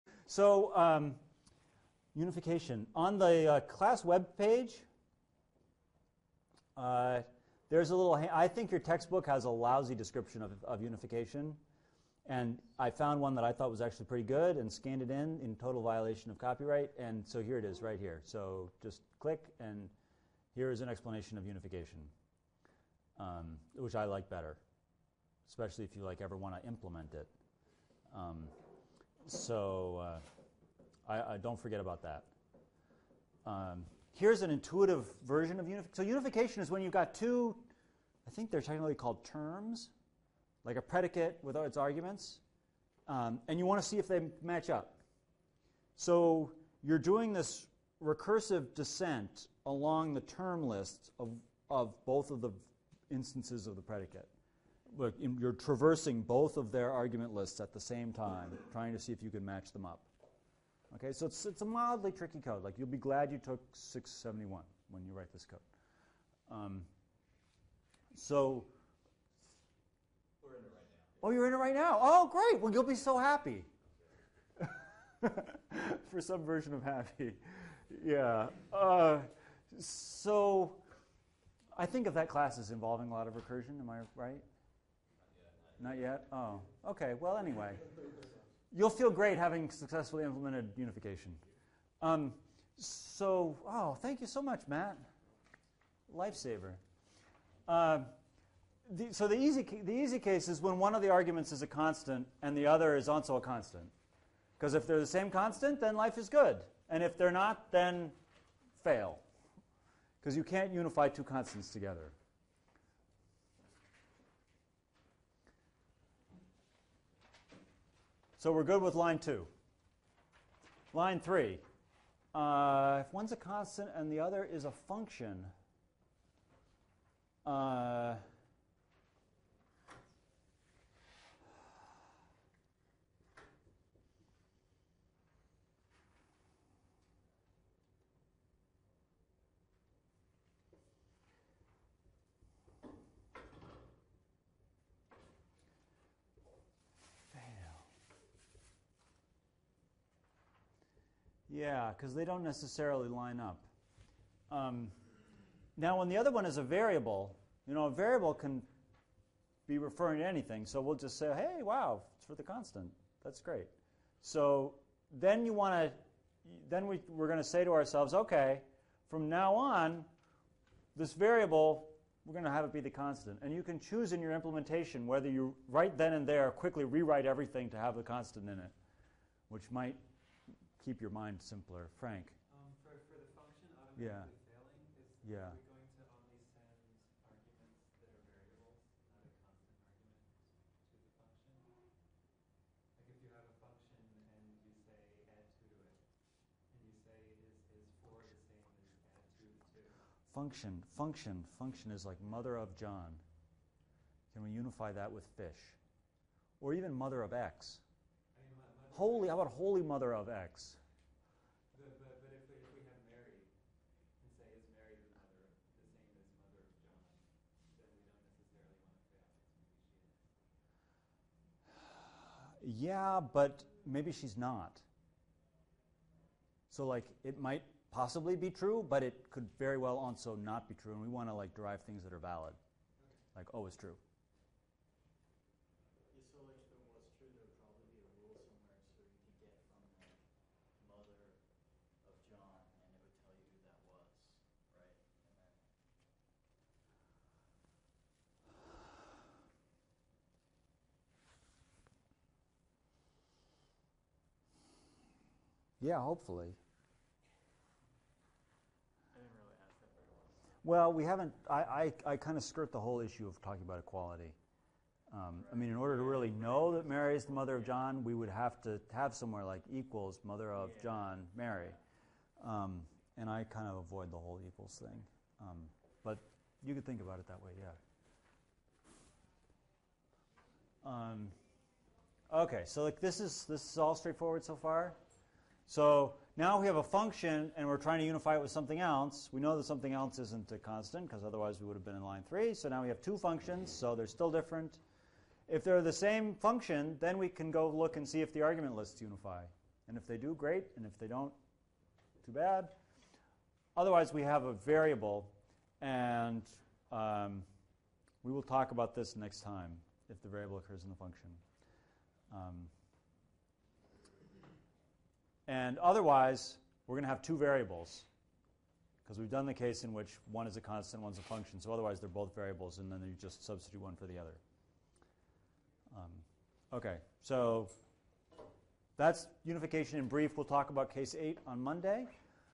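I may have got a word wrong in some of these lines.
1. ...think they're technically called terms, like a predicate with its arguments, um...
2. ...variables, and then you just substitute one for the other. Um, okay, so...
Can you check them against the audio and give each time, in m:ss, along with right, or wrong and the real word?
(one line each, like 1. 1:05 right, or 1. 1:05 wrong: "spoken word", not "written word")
1. 0:38 right
2. 5:22 right.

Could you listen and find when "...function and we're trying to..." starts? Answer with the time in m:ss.
4:46.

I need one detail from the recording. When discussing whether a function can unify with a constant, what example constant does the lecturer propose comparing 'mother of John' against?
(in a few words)
fish.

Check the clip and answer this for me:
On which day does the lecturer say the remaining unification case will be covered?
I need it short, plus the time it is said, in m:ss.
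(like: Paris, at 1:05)
Monday, at 5:31.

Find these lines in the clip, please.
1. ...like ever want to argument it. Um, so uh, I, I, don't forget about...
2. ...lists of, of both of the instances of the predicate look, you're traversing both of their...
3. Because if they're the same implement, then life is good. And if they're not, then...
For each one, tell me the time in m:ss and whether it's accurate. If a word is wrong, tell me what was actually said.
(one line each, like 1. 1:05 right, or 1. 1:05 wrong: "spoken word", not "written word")
1. 0:26 wrong: "implement", not "argument"
2. 0:50 right
3. 1:44 wrong: "constant", not "implement".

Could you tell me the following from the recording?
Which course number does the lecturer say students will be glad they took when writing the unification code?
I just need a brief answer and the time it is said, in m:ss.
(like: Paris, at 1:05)
671, at 1:03.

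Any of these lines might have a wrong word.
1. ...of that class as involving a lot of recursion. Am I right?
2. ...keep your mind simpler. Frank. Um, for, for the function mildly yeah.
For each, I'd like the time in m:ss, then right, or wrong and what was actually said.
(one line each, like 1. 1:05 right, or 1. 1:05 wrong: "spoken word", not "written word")
1. 1:22 right
2. 3:00 wrong: "automatically", not "mildly".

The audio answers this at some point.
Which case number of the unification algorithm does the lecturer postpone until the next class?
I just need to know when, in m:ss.
5:30.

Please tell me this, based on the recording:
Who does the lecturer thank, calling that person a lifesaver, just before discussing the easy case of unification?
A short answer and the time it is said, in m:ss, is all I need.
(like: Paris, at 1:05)
Matt, at 1:34.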